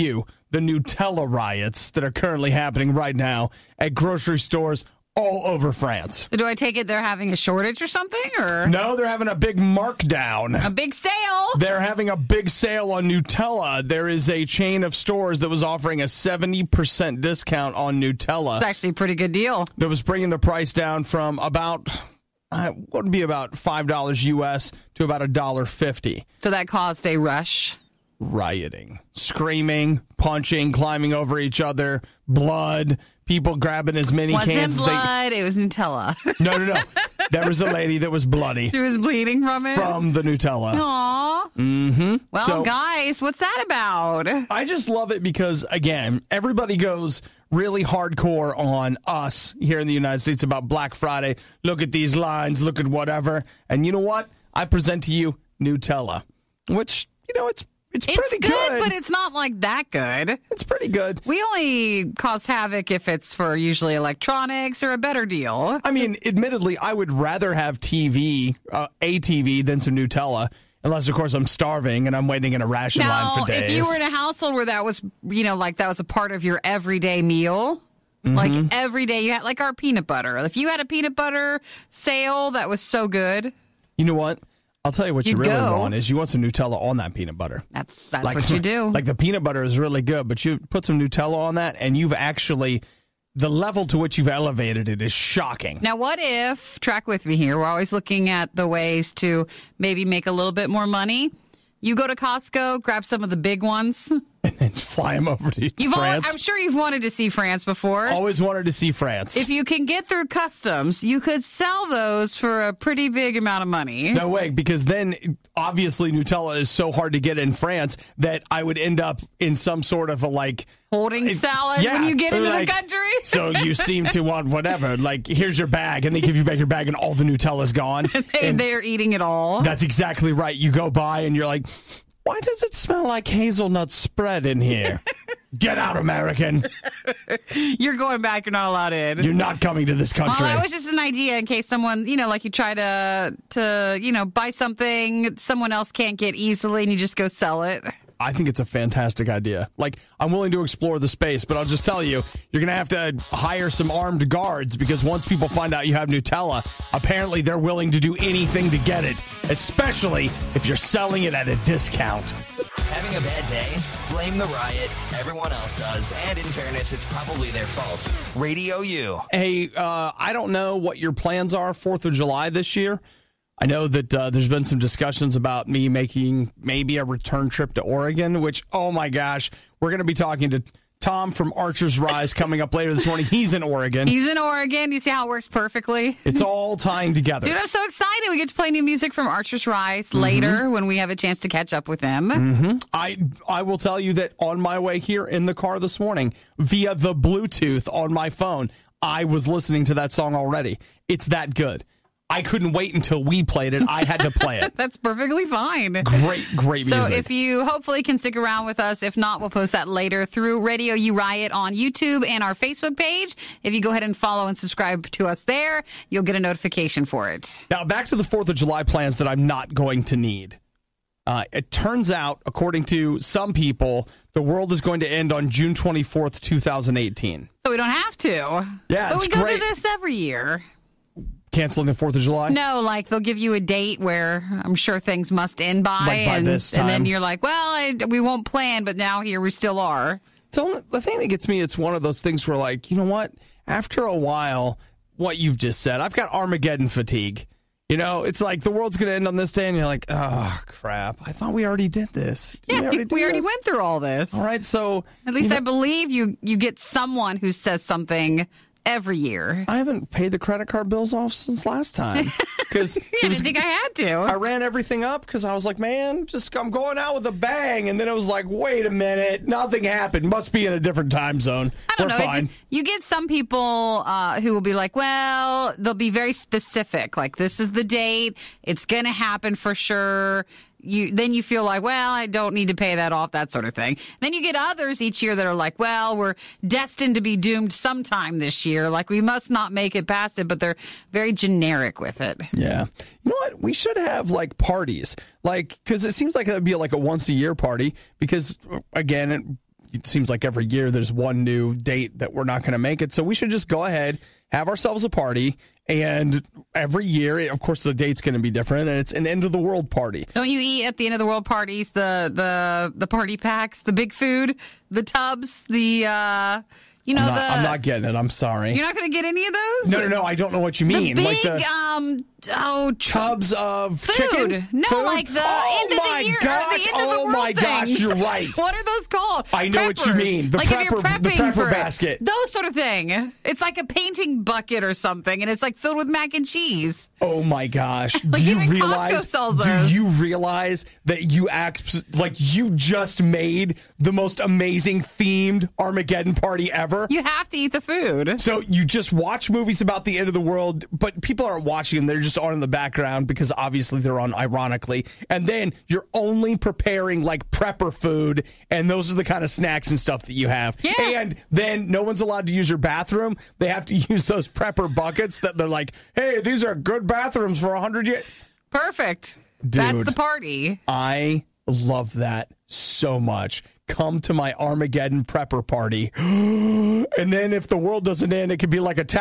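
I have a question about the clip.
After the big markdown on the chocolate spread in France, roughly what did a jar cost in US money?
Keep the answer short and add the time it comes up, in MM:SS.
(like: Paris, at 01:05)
$1.50, at 00:25.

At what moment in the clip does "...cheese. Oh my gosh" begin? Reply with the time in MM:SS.
05:36.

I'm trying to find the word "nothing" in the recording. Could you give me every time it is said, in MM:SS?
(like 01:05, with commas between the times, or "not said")
04:29.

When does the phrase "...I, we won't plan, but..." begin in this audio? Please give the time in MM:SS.
03:57.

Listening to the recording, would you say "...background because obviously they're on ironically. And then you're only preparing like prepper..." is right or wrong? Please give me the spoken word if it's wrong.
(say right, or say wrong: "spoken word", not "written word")
right.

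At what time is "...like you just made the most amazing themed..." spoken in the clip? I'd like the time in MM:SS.
05:42.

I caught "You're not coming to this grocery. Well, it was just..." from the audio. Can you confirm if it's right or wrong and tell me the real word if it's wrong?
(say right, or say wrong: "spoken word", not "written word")
wrong: "country", not "grocery".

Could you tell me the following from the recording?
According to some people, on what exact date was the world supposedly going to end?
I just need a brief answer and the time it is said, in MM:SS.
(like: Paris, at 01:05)
June 24th, 2018, at 03:45.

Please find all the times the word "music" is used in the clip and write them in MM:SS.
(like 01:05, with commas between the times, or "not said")
03:08, 03:26.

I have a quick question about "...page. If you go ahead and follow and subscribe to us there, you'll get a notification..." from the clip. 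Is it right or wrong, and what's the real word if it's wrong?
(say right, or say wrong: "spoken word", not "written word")
right.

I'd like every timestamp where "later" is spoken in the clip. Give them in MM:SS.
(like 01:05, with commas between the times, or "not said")
03:02, 03:10, 03:29.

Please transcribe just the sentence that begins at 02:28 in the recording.
I think it's a fantastic idea.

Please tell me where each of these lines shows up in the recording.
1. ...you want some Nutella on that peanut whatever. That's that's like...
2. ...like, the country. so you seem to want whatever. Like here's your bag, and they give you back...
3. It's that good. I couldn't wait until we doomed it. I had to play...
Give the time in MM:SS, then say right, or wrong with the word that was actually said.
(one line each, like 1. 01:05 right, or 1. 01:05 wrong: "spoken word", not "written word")
1. 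01:26 wrong: "butter", not "whatever"
2. 02:02 right
3. 03:21 wrong: "played", not "doomed".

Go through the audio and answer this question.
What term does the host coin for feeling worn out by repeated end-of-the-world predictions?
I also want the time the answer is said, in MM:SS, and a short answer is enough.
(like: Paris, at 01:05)
Armageddon fatigue, at 04:06.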